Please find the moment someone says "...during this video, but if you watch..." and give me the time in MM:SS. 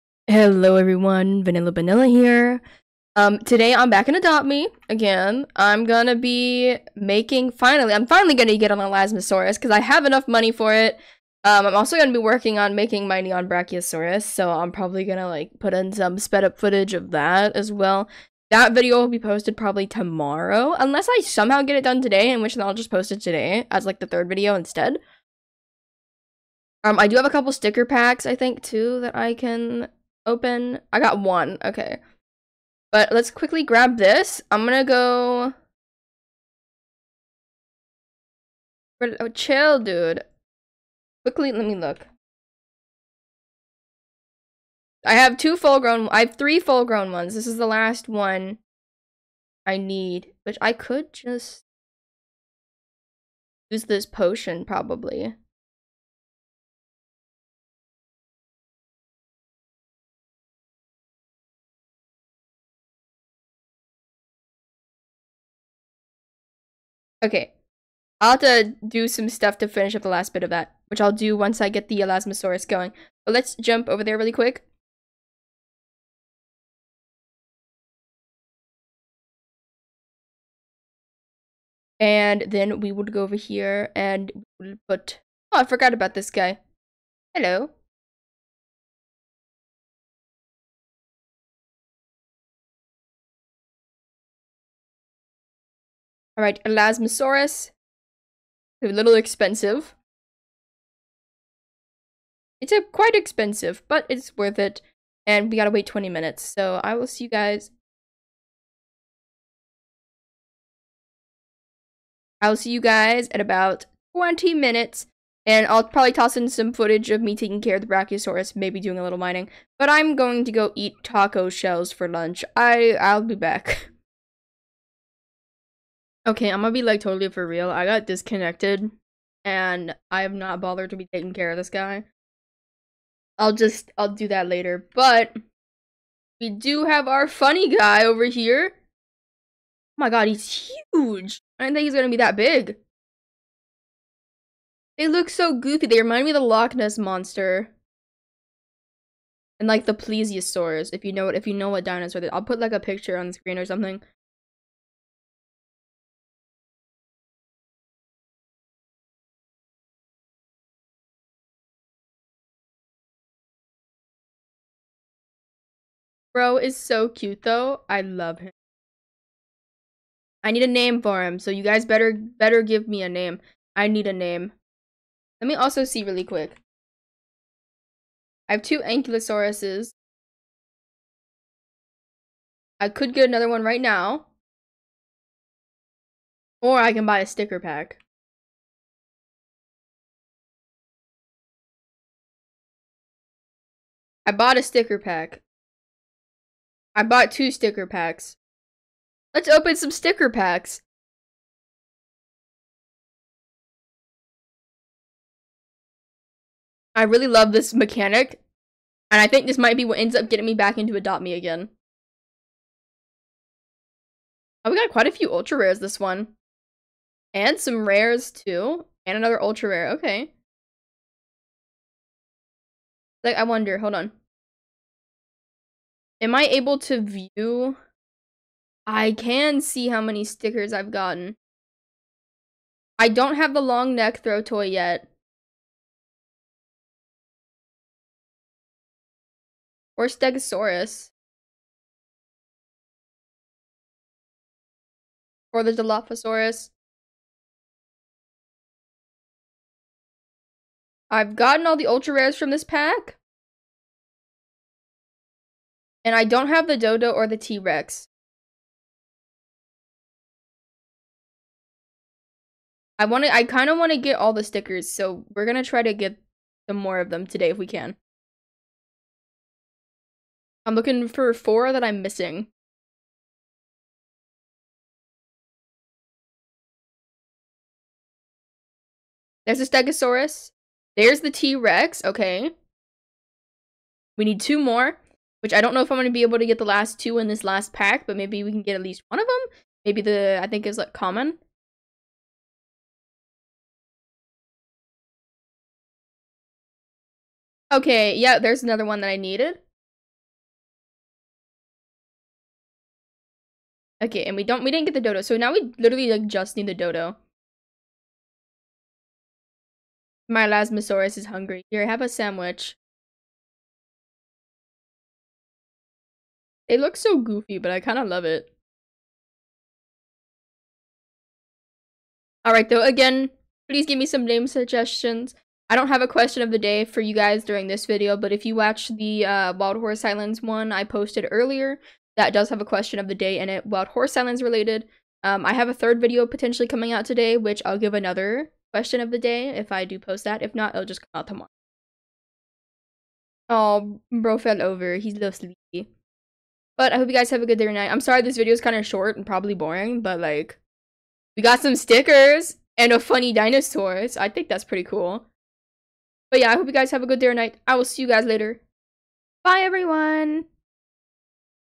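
05:27.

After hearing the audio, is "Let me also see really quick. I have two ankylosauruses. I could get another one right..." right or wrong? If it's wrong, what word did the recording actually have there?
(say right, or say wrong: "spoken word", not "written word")
right.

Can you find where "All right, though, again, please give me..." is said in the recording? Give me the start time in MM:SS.
05:22.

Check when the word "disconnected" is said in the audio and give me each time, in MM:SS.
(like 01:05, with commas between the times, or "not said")
02:08.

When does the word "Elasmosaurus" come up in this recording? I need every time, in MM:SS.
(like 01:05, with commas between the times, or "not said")
00:08, 01:12, 01:36.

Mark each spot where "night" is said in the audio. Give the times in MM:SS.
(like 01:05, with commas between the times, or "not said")
05:47, 05:57.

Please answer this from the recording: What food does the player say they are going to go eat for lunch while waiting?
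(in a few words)
Taco shells.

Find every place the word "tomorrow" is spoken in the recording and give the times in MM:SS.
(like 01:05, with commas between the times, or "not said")
00:19, 05:41.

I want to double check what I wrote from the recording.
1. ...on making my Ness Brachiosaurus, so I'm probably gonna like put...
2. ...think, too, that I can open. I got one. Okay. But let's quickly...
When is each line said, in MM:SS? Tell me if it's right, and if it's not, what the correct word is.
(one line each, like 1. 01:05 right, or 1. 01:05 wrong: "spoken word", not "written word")
1. 00:12 wrong: "Neon", not "Ness"
2. 00:28 right.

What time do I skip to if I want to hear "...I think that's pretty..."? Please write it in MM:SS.
05:54.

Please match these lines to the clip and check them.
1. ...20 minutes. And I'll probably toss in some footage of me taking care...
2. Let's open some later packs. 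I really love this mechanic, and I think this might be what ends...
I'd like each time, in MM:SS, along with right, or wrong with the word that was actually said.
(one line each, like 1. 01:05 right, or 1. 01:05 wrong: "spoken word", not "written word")
1. 01:54 right
2. 03:19 wrong: "sticker", not "later".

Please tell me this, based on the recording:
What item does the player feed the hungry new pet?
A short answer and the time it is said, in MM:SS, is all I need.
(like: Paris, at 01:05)
Sandwich, at 05:12.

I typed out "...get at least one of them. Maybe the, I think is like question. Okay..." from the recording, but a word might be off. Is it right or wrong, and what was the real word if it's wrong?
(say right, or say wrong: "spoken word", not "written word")
wrong: "common", not "question".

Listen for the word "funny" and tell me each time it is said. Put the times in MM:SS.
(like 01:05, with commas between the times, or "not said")
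02:17, 05:52.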